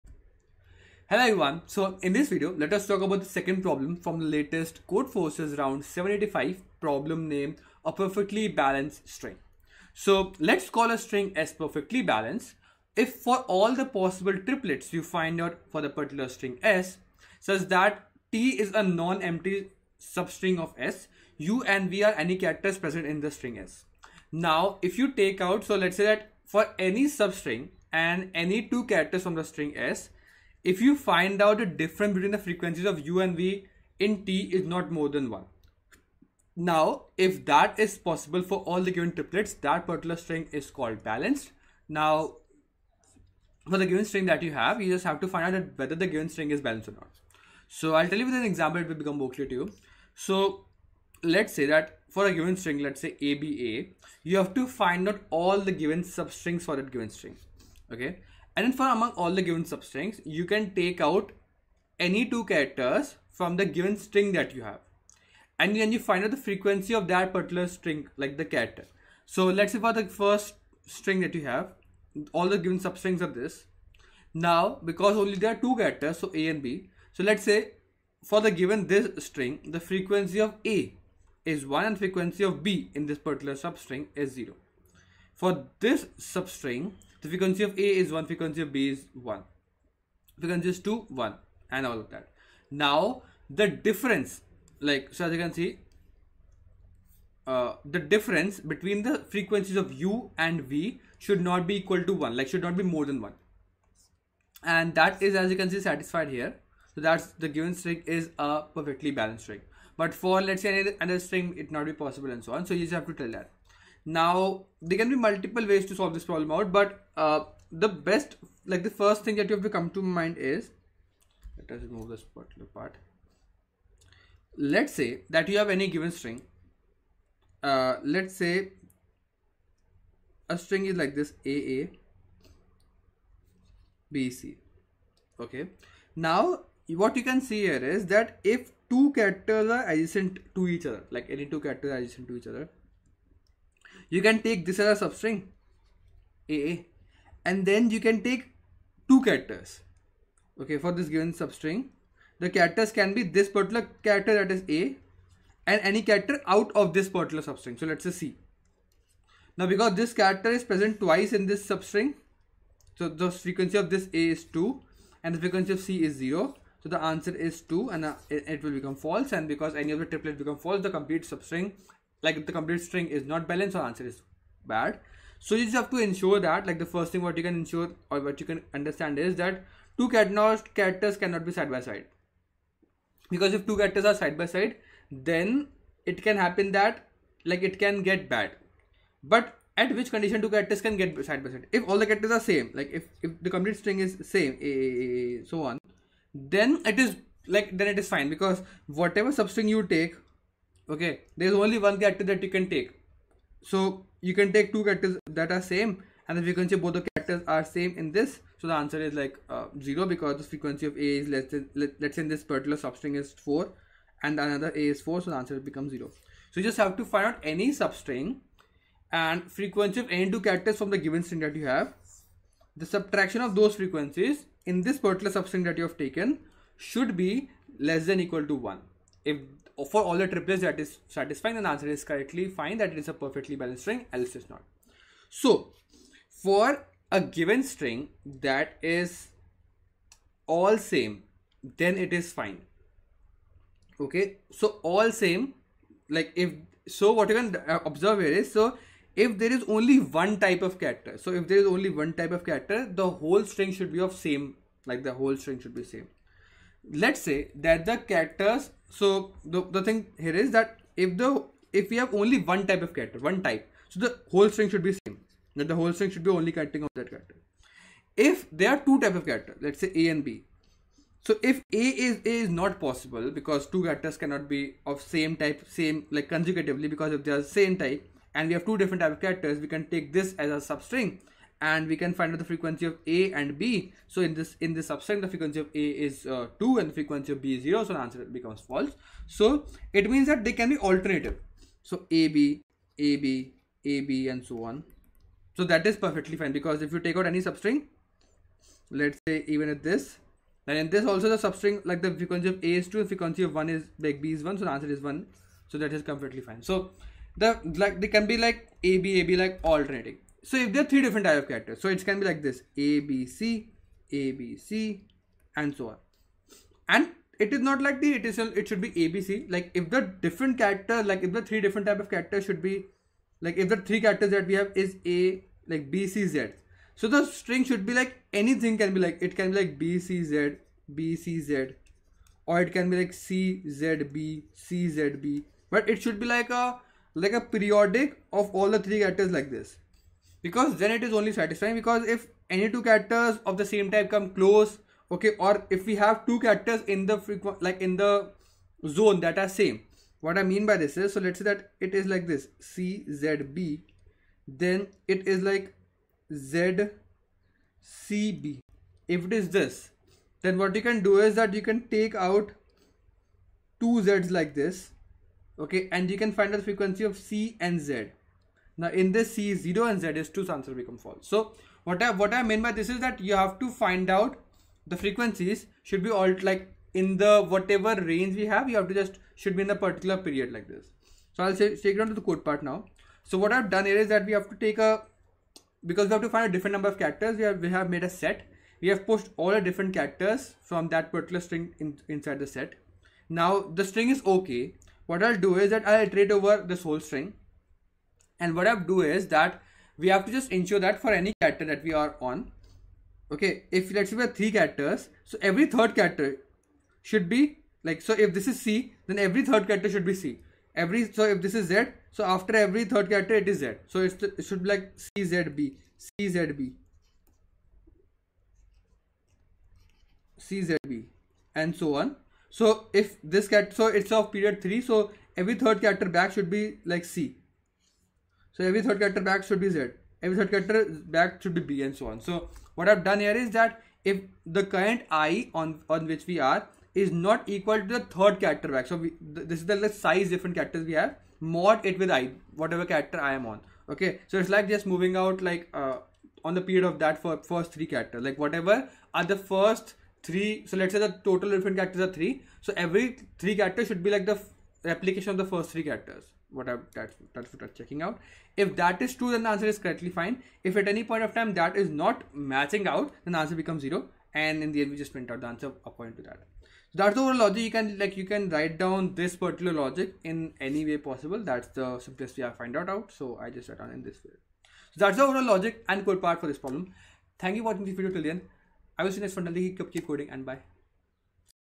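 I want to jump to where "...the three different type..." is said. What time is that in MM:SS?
05:21.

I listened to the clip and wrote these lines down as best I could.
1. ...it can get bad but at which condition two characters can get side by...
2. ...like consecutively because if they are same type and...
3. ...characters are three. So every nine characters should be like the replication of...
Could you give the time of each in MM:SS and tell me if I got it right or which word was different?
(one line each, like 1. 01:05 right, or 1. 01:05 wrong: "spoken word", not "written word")
1. 03:07 right
2. 04:36 right
3. 07:31 wrong: "three", not "nine".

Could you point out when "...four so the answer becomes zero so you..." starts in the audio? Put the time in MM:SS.
03:35.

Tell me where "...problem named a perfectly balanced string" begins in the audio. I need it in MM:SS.
00:06.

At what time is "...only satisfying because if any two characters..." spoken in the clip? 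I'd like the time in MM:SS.
05:41.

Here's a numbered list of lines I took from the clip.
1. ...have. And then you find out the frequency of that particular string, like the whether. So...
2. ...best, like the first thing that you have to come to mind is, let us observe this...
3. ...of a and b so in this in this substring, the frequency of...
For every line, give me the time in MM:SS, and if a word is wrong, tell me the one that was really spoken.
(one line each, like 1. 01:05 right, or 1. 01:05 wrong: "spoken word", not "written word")
1. 01:04 wrong: "character", not "whether"
2. 01:57 wrong: "remove", not "observe"
3. 04:42 right.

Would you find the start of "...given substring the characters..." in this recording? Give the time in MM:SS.
02:31.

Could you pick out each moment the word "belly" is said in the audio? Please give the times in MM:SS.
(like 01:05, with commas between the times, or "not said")
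not said.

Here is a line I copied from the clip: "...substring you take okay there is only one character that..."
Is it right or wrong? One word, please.
right.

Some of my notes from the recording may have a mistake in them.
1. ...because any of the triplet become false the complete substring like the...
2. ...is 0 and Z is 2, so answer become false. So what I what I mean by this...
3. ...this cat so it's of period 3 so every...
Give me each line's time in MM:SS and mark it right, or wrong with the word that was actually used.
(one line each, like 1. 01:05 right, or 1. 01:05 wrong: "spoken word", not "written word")
1. 02:49 right
2. 06:09 right
3. 07:03 right.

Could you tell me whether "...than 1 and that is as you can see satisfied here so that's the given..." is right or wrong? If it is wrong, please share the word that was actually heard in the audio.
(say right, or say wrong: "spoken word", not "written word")
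right.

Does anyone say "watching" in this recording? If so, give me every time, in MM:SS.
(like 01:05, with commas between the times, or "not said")
07:57.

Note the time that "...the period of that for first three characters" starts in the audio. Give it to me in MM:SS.
07:26.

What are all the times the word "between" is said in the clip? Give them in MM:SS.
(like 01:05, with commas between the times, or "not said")
00:32, 01:38.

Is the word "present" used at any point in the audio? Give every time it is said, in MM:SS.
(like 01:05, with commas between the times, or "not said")
00:22, 02:40.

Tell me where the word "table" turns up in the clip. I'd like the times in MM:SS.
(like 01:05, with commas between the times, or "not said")
not said.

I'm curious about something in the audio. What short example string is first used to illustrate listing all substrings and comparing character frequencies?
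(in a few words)
ABA.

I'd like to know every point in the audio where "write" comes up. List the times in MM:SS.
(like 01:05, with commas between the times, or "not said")
07:48, 07:53.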